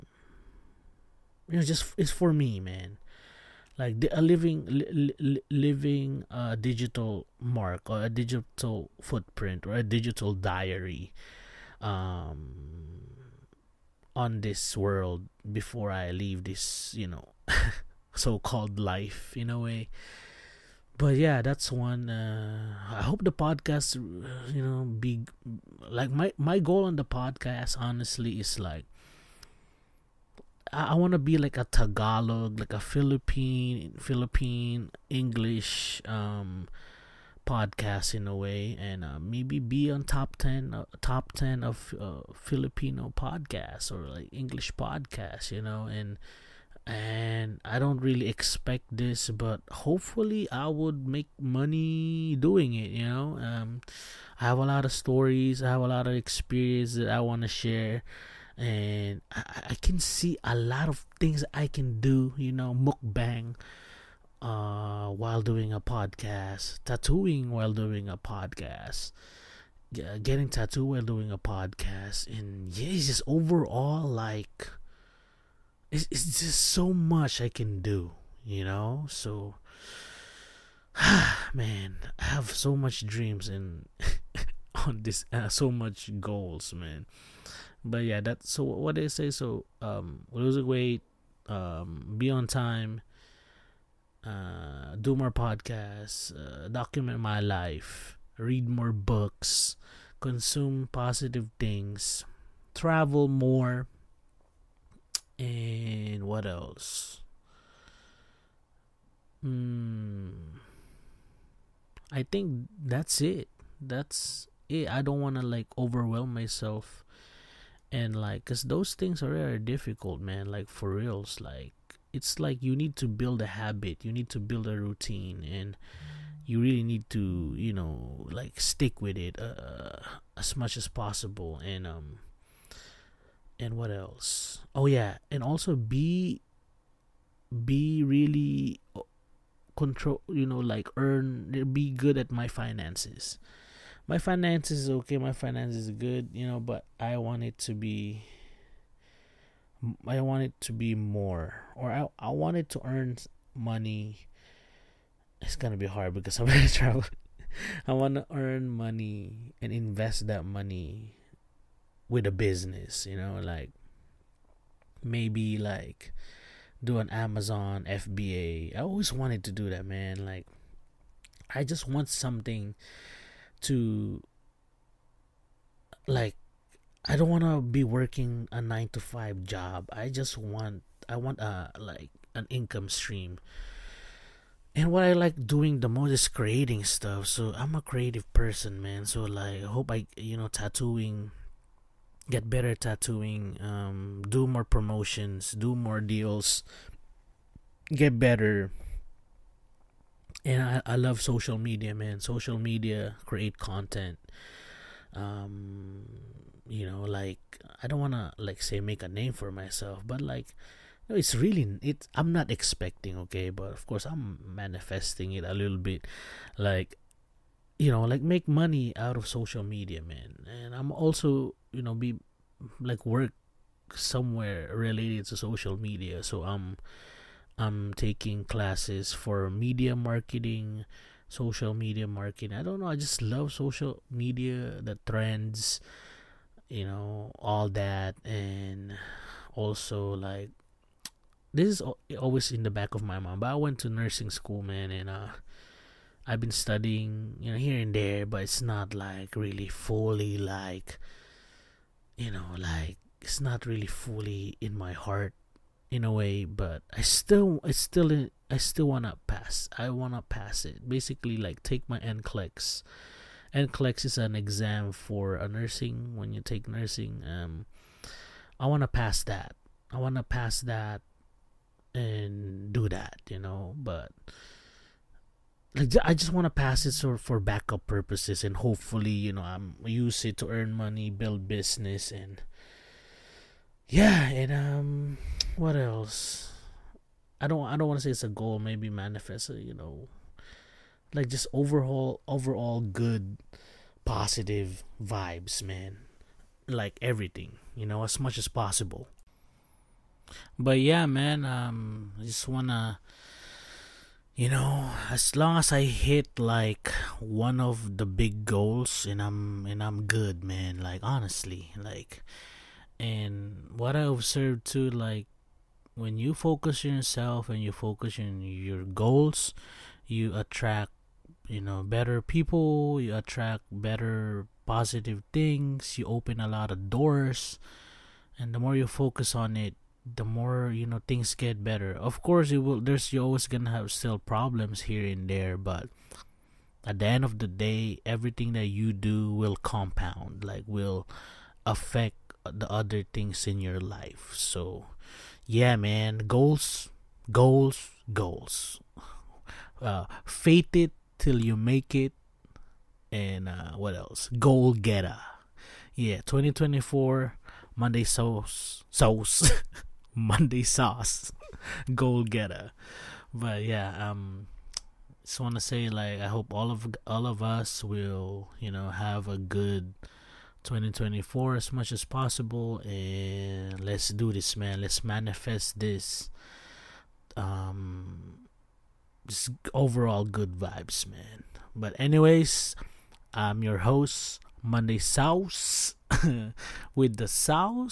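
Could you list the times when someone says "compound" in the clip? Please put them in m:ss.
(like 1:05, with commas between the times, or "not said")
5:39.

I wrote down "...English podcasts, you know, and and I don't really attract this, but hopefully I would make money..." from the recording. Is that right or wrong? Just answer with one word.
wrong.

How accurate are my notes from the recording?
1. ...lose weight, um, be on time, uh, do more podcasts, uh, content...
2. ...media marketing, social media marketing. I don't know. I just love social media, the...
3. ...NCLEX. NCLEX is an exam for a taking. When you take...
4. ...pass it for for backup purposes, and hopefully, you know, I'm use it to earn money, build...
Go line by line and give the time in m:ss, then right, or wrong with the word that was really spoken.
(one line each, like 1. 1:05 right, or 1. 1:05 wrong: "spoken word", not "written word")
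1. 1:30 wrong: "document", not "content"
2. 3:49 right
3. 4:21 wrong: "nursing", not "taking"
4. 4:36 right.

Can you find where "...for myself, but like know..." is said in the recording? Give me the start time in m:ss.
3:29.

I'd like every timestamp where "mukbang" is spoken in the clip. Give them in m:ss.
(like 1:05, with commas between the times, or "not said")
1:02.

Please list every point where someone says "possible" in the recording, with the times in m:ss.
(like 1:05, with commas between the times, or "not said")
2:10, 4:58, 6:12.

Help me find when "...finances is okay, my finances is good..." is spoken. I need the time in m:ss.
2:24.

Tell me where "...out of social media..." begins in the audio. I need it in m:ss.
3:38.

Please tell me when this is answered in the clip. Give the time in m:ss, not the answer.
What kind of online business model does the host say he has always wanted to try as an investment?
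2:47.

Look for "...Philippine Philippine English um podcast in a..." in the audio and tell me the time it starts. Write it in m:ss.
0:32.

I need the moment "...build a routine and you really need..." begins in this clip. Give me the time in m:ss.
2:04.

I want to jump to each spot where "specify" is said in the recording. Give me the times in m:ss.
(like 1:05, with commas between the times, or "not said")
not said.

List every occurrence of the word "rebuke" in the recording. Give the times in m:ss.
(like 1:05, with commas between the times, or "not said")
not said.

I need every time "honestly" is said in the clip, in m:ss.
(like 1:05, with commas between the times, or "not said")
0:27, 5:11.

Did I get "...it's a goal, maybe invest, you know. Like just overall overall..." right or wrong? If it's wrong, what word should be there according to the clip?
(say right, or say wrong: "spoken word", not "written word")
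wrong: "manifest", not "invest".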